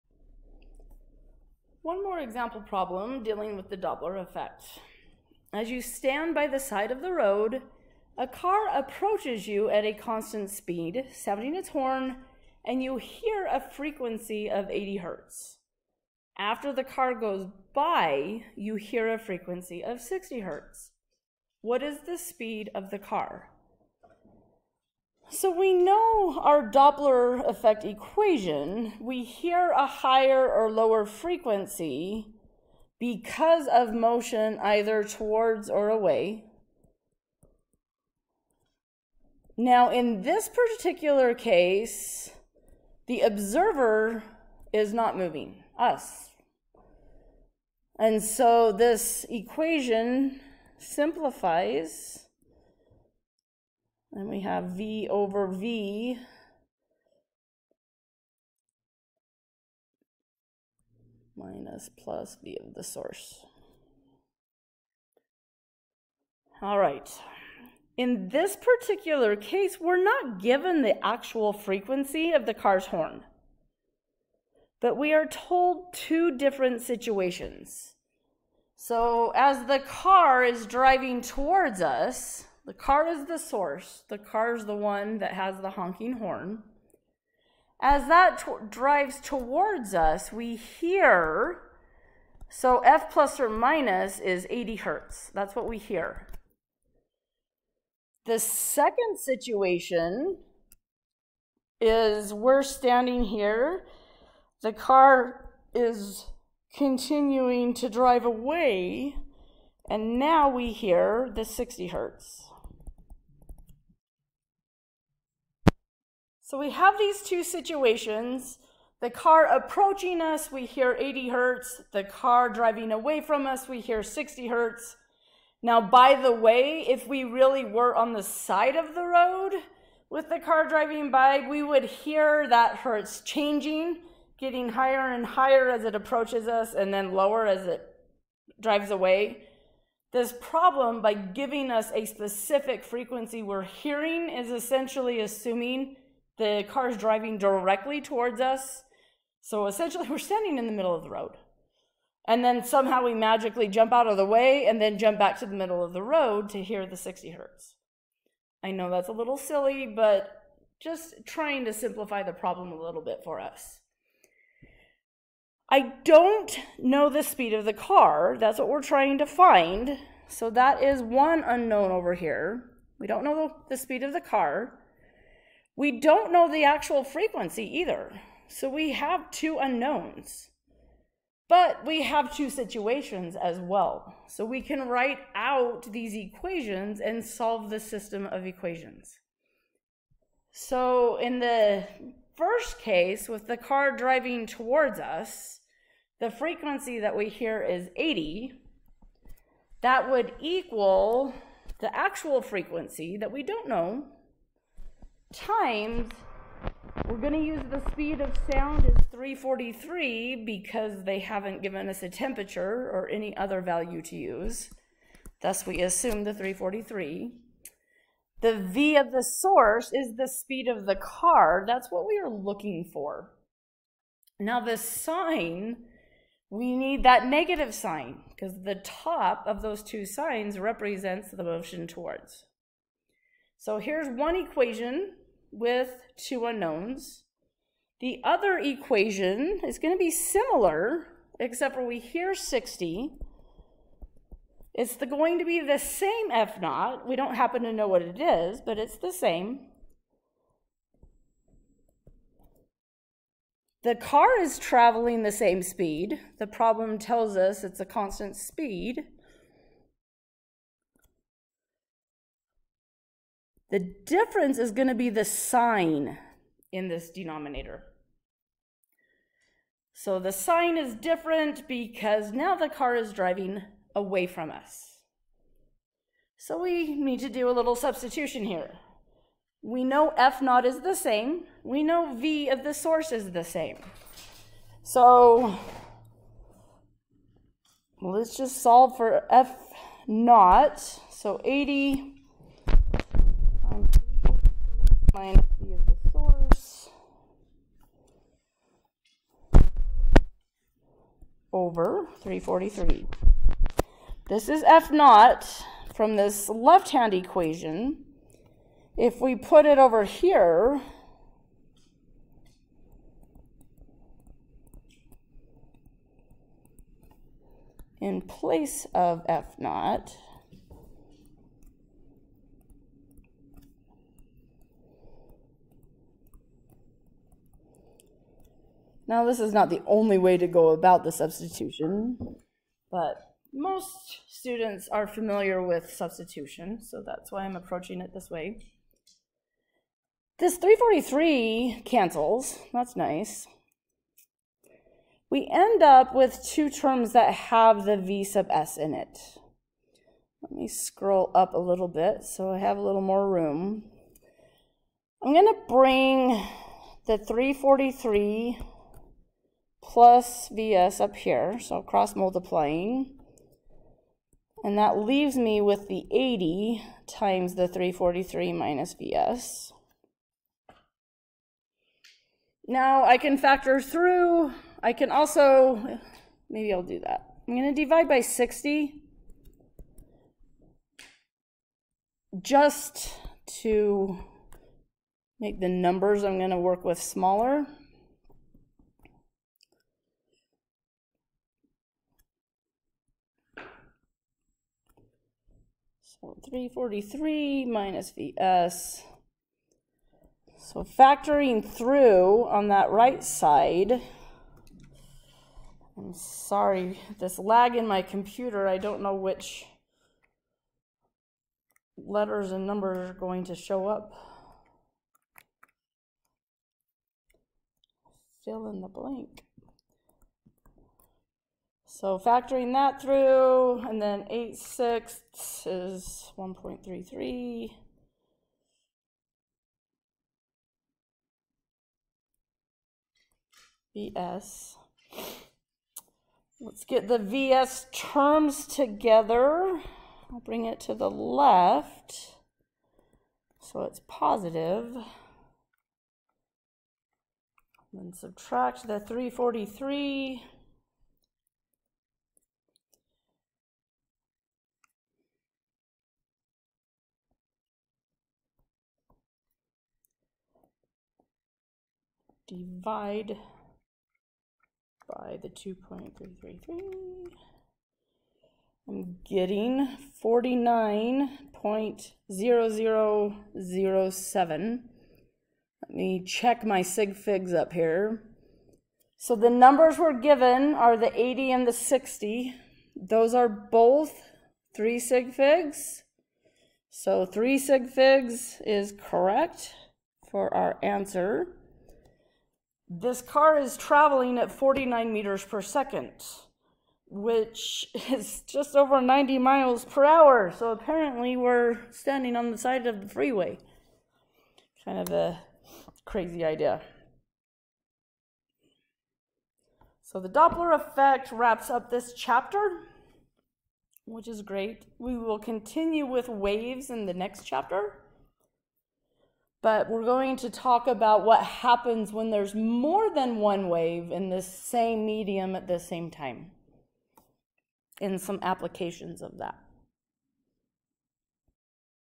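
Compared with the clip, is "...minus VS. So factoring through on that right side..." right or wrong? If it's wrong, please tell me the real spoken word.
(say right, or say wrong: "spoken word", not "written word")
right.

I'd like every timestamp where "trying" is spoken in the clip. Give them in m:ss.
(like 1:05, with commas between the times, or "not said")
2:41, 2:48.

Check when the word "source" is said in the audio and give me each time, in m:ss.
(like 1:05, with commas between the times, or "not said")
1:02, 1:23, 3:39, 4:42, 4:56.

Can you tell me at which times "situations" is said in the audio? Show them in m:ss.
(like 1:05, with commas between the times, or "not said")
1:16, 1:39, 1:57, 3:02.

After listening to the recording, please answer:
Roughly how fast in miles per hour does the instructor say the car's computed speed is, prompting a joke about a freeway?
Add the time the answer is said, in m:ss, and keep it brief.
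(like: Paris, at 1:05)
just over 90 miles per hour, at 8:18.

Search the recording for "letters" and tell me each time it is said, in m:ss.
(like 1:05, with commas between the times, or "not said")
6:51.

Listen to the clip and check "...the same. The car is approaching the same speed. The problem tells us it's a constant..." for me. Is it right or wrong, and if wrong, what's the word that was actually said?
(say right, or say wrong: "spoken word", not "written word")
wrong: "traveling", not "approaching".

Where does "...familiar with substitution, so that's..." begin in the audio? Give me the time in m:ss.
5:35.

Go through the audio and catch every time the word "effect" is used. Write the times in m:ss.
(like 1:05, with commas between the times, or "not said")
0:04, 0:27, 8:30.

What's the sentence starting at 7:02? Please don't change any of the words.
So factoring that through, and then 8 sixths is 1.33.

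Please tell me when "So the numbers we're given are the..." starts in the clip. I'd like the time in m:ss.
7:59.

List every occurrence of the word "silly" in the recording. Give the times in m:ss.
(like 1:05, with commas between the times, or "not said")
2:39.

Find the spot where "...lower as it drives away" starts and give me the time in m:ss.
2:17.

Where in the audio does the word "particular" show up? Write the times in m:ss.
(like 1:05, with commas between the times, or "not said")
0:40, 1:08.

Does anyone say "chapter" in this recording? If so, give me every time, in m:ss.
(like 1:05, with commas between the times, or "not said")
8:32, 8:37.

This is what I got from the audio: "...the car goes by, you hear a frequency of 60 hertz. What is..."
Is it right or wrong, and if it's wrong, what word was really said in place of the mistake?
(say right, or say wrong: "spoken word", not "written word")
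right.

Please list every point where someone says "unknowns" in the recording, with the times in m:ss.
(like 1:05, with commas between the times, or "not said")
2:51, 2:59, 3:56.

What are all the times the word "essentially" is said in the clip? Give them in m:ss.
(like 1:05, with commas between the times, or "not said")
2:24, 2:29.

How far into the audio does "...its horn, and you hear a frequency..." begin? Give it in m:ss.
0:11.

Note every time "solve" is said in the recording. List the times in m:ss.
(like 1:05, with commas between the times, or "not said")
3:07, 4:48.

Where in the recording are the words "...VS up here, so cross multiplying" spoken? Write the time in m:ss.
6:00.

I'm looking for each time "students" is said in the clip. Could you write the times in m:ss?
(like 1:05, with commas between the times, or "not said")
5:34.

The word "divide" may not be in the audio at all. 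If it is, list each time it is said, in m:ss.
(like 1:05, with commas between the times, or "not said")
6:17, 7:42.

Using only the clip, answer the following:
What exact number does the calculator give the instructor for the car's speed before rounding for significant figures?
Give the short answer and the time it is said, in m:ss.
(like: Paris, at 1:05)
49.0007, at 7:50.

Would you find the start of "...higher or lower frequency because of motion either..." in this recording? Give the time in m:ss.
0:29.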